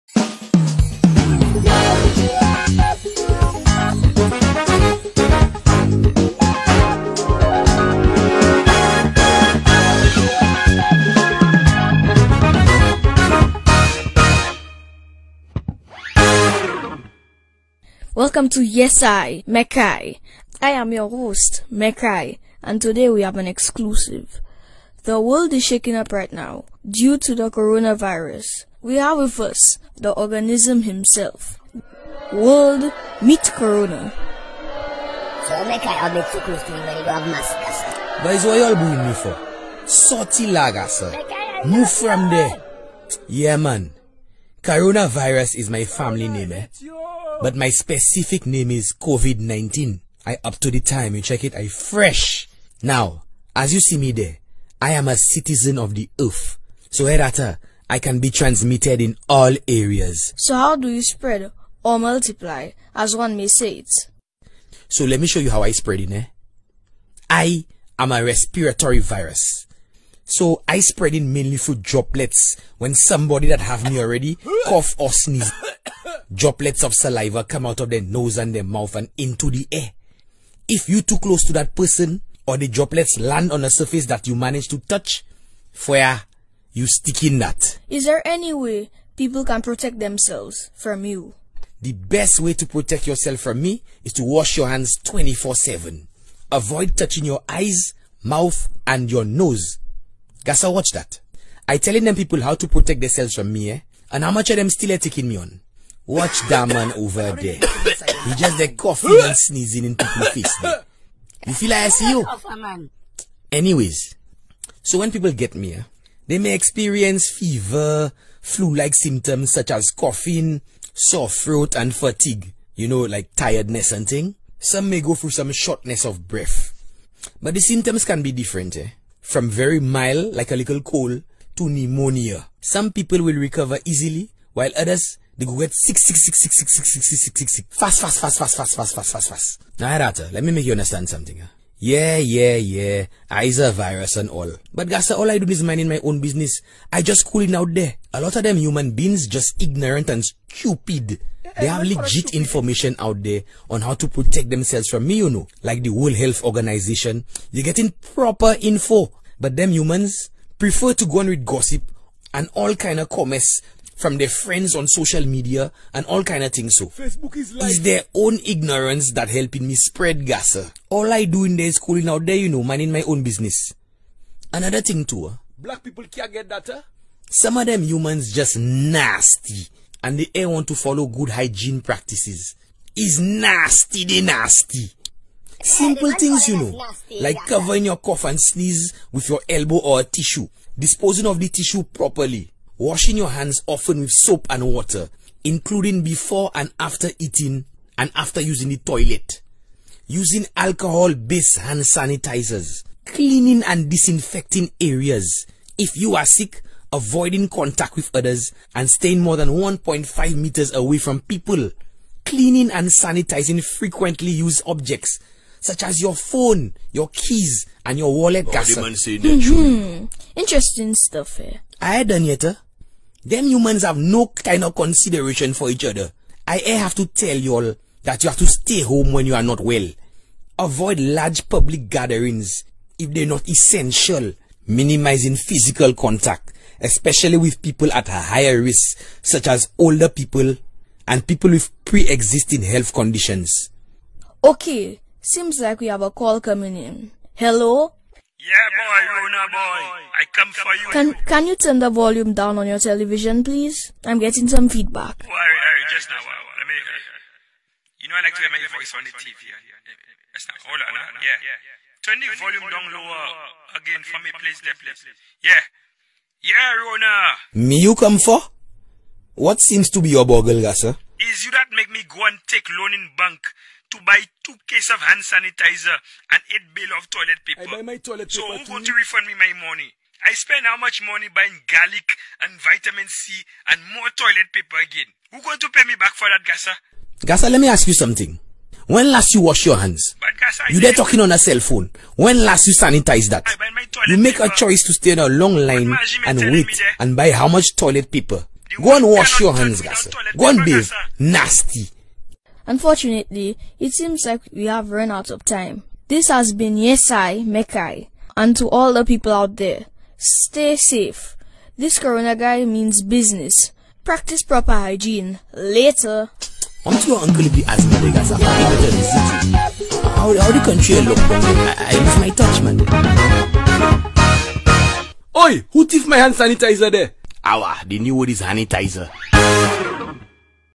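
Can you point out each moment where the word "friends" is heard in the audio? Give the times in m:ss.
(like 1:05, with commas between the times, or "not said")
2:44.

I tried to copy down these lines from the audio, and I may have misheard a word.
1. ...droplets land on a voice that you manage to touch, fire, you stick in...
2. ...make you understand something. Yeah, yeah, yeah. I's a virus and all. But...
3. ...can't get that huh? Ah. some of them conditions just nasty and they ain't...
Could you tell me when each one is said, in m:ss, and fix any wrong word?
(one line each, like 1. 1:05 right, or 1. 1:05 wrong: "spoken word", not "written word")
1. 1:22 wrong: "surface", not "voice"
2. 2:20 right
3. 2:56 wrong: "humans", not "conditions".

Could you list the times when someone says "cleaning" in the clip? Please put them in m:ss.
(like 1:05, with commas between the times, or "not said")
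3:23, 3:32.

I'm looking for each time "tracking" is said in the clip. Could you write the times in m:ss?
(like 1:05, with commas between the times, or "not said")
not said.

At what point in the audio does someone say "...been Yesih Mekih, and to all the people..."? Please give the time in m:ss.
5:06.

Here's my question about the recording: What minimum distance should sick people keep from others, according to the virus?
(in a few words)
1.5 meters.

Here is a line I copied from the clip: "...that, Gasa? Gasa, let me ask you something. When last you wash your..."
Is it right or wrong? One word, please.
right.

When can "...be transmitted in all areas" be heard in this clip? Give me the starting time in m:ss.
0:58.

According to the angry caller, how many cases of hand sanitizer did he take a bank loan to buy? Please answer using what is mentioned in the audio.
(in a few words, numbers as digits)
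2.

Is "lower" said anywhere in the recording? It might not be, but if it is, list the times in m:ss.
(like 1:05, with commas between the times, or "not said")
4:22.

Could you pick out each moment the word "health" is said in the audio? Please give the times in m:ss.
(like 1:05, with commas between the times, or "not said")
2:36, 4:02.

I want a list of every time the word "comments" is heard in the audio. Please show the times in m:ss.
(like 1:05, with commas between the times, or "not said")
2:43.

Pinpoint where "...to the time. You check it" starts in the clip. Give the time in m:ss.
0:50.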